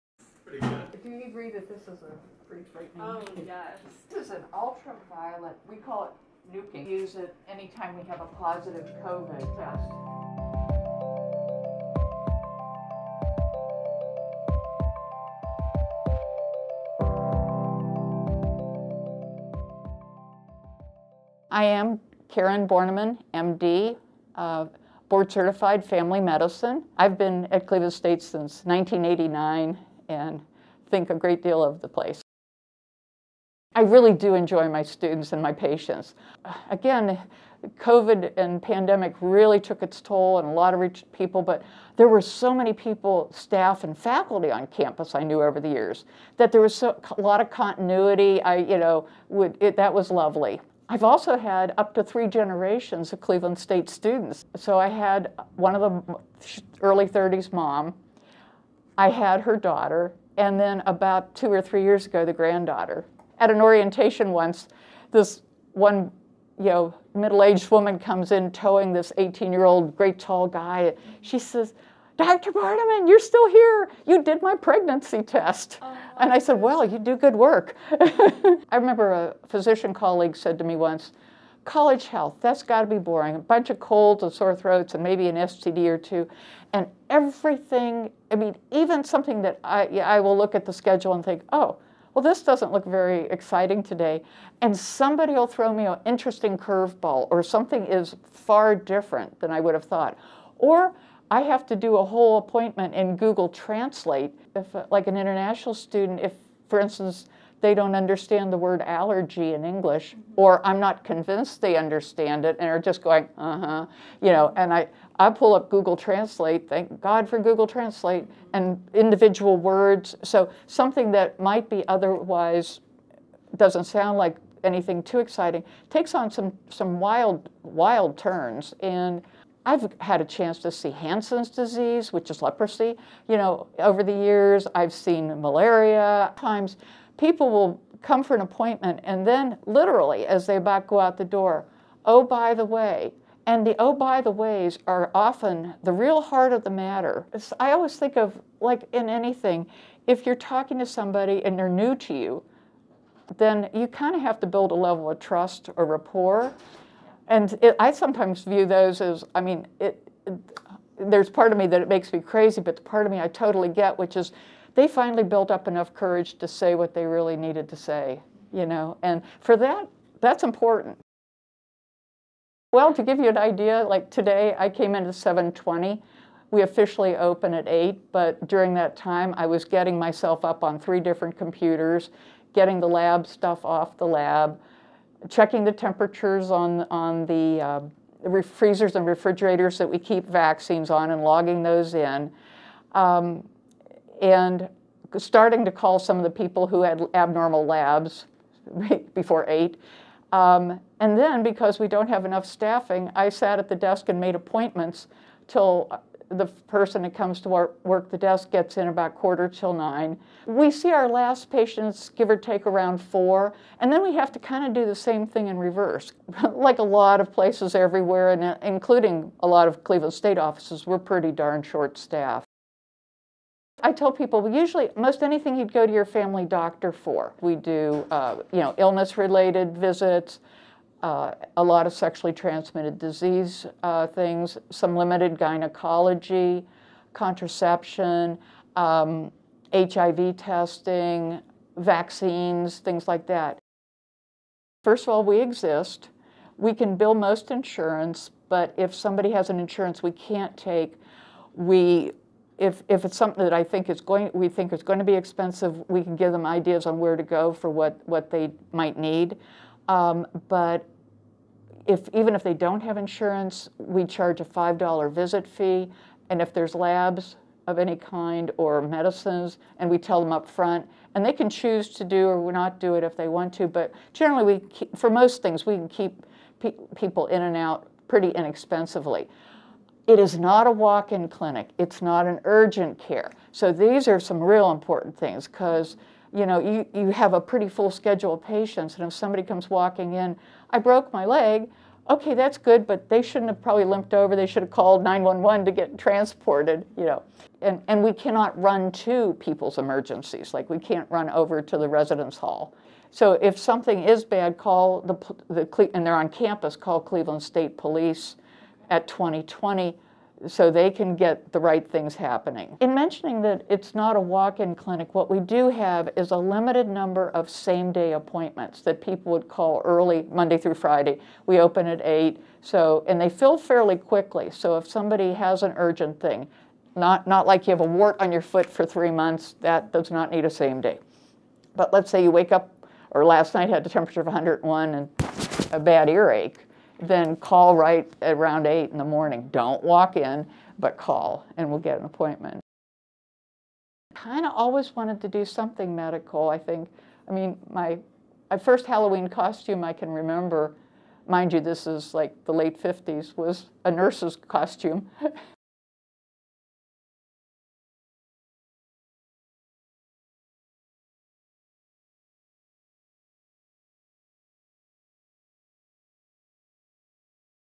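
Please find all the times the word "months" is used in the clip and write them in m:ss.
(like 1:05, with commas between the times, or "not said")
5:29.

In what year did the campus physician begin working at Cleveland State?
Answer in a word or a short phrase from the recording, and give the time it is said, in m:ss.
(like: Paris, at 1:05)
1989, at 0:28.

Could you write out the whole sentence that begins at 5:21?
We open at 8, so and they fill fairly quickly.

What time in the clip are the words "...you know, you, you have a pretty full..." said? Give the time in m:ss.
4:46.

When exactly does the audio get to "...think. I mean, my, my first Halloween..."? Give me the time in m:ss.
5:46.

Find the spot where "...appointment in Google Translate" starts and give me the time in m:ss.
1:42.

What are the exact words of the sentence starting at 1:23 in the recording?
A bunch of colds and sore throats and maybe an STD or two.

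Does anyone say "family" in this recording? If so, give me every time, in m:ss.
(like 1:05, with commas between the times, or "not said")
0:25, 3:46.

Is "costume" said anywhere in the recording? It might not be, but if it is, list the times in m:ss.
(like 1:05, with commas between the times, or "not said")
5:49, 5:54.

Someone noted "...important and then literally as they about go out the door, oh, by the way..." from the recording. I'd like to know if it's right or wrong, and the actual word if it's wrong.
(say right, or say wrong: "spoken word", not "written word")
wrong: "appointment", not "important".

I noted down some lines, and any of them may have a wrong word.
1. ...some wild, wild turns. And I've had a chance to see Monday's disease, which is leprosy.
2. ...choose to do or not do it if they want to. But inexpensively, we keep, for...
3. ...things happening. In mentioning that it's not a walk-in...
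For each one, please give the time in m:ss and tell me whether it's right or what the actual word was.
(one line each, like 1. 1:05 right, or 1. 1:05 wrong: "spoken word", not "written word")
1. 2:06 wrong: "Hansen", not "Monday"
2. 4:31 wrong: "generally", not "inexpensively"
3. 5:11 right.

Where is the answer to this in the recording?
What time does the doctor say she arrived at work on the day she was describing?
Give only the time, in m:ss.
2:55.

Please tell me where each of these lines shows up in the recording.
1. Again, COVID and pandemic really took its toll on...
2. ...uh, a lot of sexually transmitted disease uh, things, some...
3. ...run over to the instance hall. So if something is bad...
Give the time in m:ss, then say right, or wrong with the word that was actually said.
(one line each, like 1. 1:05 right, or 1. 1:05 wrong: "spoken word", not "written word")
1. 0:36 right
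2. 3:51 right
3. 5:01 wrong: "residence", not "instance".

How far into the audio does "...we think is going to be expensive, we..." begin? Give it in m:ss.
4:14.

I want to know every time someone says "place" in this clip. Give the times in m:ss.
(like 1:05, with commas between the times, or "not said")
0:31, 3:37.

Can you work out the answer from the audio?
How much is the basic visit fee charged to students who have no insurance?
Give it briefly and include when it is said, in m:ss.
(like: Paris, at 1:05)
$5, at 4:24.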